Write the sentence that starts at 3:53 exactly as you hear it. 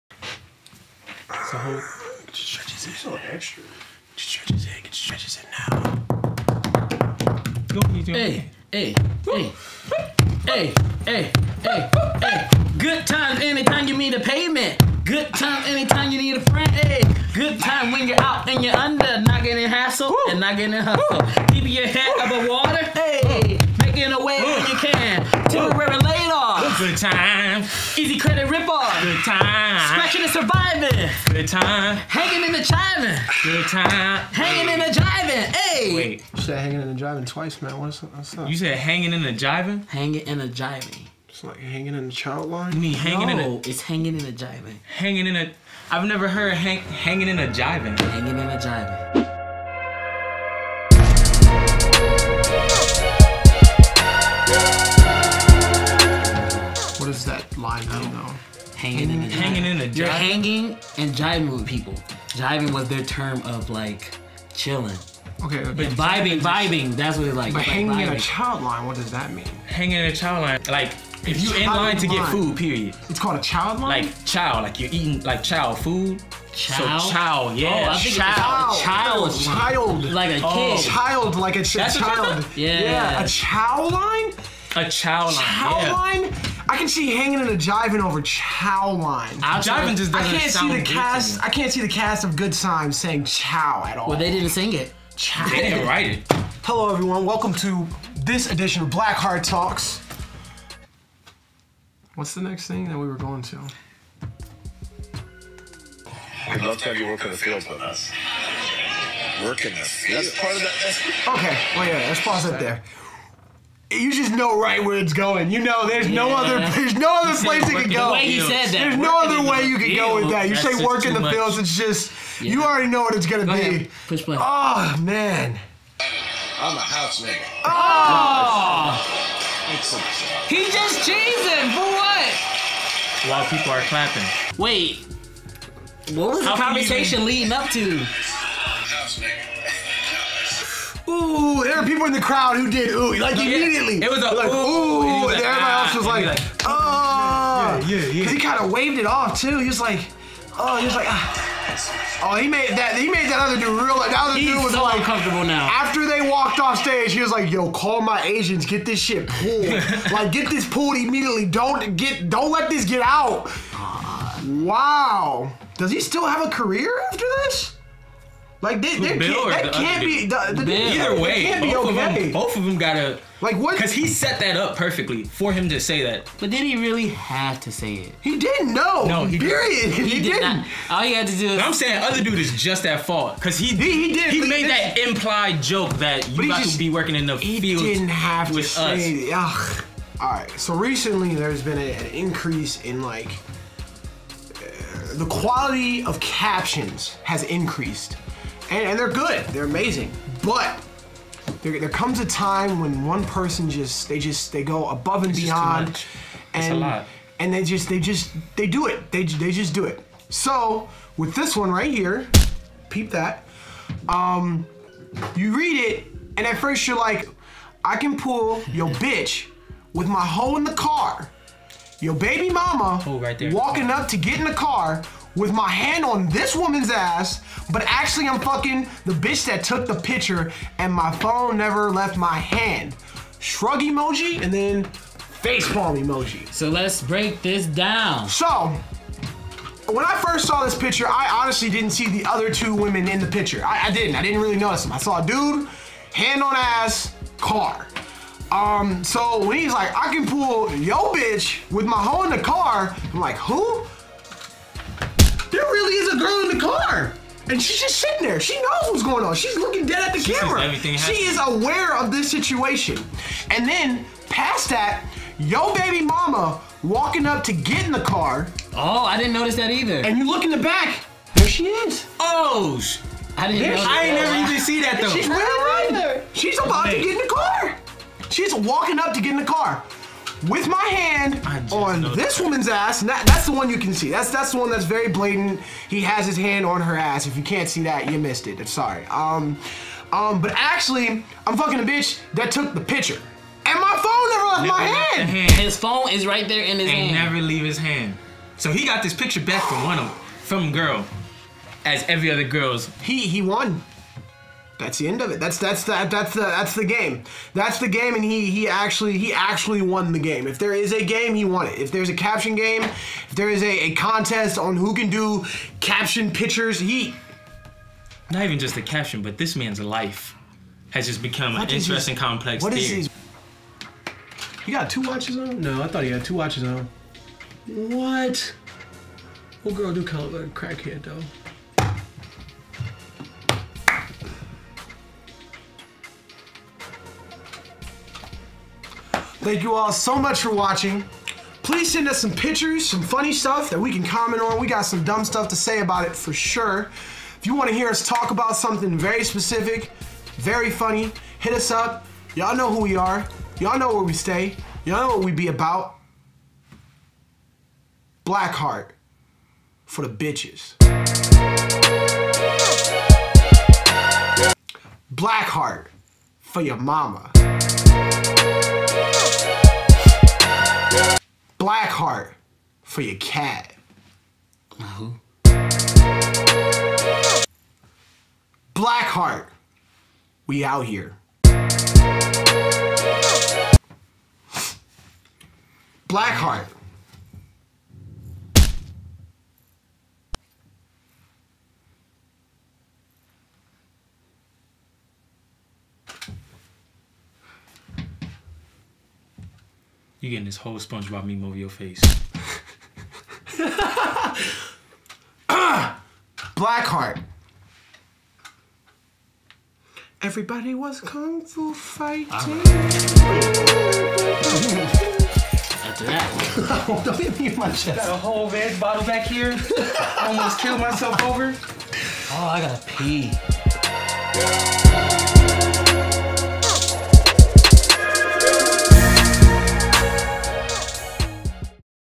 Shrug emoji and then face palm emoji.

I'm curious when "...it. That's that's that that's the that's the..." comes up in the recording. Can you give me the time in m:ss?
5:05.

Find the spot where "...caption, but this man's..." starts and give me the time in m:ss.
5:18.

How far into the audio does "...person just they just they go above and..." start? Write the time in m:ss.
3:23.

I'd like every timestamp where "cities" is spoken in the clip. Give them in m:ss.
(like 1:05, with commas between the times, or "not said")
not said.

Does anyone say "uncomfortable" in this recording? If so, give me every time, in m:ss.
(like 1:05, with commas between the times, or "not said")
2:34.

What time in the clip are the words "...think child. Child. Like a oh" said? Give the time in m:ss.
1:17.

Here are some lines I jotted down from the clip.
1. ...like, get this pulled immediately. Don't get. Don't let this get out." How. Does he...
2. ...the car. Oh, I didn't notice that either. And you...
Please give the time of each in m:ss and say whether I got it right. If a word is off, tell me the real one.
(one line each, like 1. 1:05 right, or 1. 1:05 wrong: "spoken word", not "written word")
1. 2:40 wrong: "Wow", not "How"
2. 4:27 right.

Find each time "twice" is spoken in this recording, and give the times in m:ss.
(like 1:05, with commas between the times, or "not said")
0:37.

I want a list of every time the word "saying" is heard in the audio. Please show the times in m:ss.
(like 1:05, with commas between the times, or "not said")
1:32, 3:01.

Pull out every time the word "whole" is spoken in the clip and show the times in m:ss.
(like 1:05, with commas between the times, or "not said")
0:01, 6:40, 6:58.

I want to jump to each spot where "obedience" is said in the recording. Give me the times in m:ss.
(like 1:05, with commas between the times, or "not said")
not said.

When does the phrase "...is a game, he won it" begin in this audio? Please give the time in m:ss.
5:10.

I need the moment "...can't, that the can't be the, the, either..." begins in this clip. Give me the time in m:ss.
2:49.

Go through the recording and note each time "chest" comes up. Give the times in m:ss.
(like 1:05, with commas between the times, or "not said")
6:57.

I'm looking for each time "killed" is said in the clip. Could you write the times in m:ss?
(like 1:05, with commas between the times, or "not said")
7:00.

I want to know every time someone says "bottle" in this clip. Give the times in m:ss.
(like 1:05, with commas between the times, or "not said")
6:58.